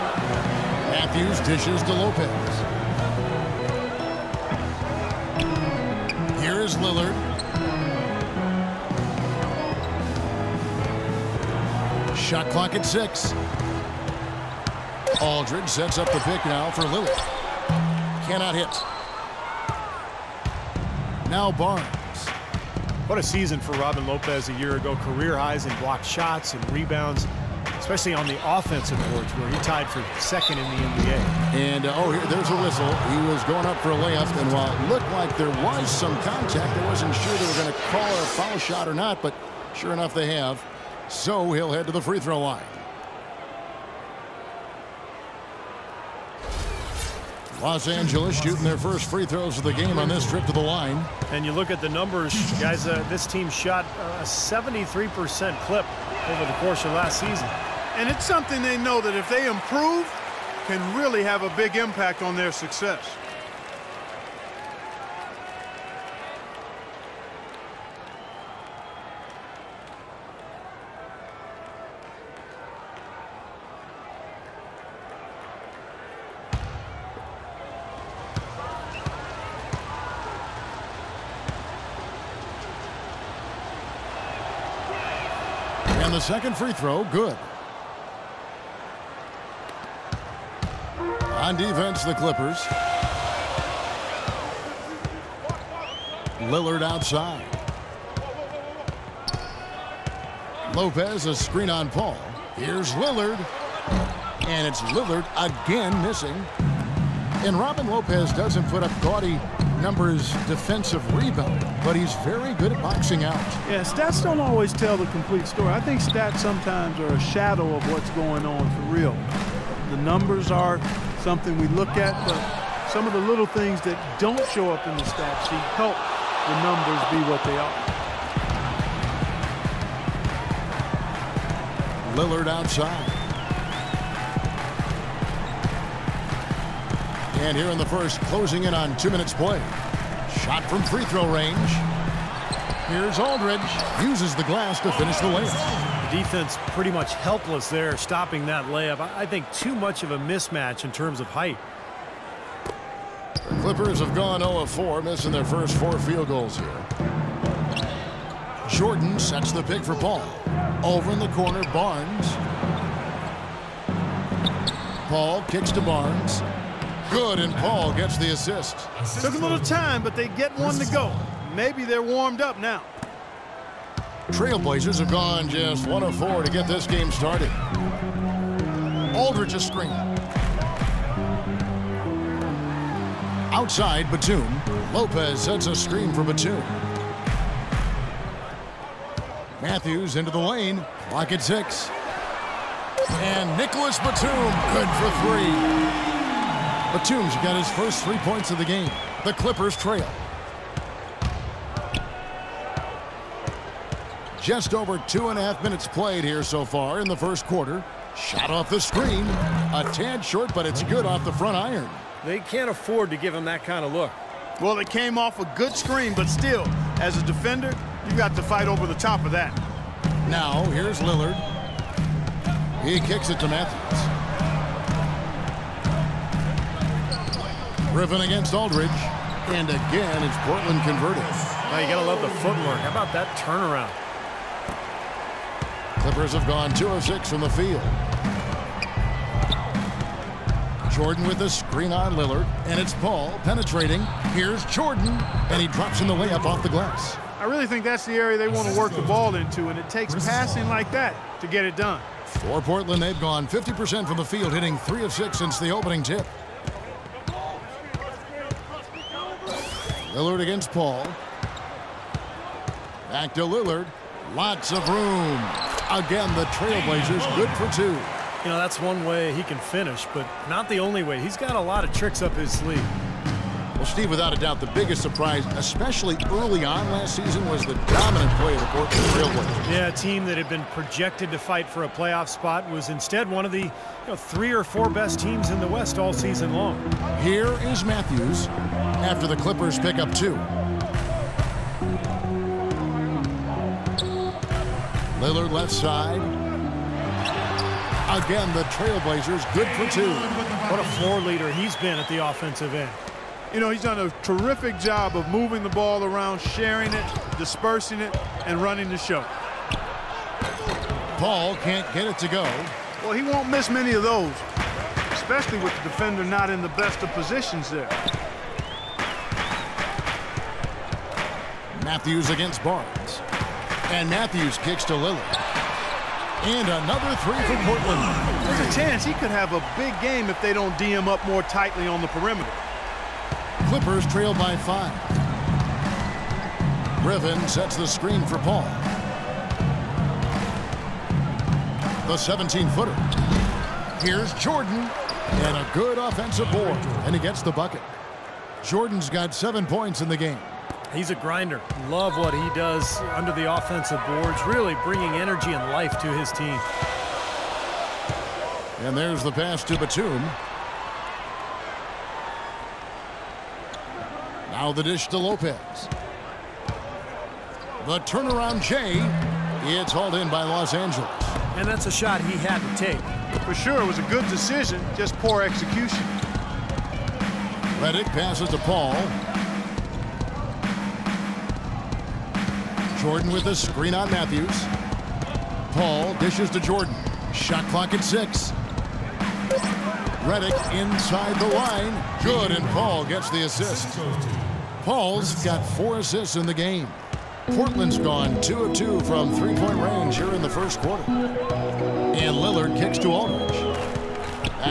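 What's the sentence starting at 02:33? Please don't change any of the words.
The Clippers have gone 0-4, missing their first four field goals here.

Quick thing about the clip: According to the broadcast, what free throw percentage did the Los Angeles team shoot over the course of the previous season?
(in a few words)
73%.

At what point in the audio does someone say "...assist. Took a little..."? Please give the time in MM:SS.
02:48.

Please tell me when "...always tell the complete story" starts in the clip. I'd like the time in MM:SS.
01:54.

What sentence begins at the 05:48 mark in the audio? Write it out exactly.
Jordan's got seven points in the game.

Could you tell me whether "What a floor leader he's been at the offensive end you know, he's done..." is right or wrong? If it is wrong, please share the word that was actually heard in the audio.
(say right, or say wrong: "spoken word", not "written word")
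right.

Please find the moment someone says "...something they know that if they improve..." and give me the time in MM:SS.
00:58.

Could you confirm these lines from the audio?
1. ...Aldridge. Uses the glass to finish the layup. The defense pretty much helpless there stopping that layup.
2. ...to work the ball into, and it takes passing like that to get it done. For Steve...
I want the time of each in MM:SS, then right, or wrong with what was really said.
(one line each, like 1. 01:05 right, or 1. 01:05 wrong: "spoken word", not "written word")
1. 02:23 right
2. 04:08 wrong: "Portland", not "Steve".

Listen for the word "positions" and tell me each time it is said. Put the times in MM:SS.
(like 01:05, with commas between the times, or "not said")
05:17.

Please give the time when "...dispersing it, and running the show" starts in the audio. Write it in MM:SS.
05:07.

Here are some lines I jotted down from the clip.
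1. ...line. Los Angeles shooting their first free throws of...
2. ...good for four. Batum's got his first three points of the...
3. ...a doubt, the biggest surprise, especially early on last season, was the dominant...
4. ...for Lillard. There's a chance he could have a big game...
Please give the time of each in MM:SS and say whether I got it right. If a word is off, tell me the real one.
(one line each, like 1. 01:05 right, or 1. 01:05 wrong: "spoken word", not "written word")
1. 00:42 right
2. 03:14 wrong: "three", not "four"
3. 04:34 right
4. 05:27 wrong: "Portland", not "Lillard".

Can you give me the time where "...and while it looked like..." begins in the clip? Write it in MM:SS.
00:34.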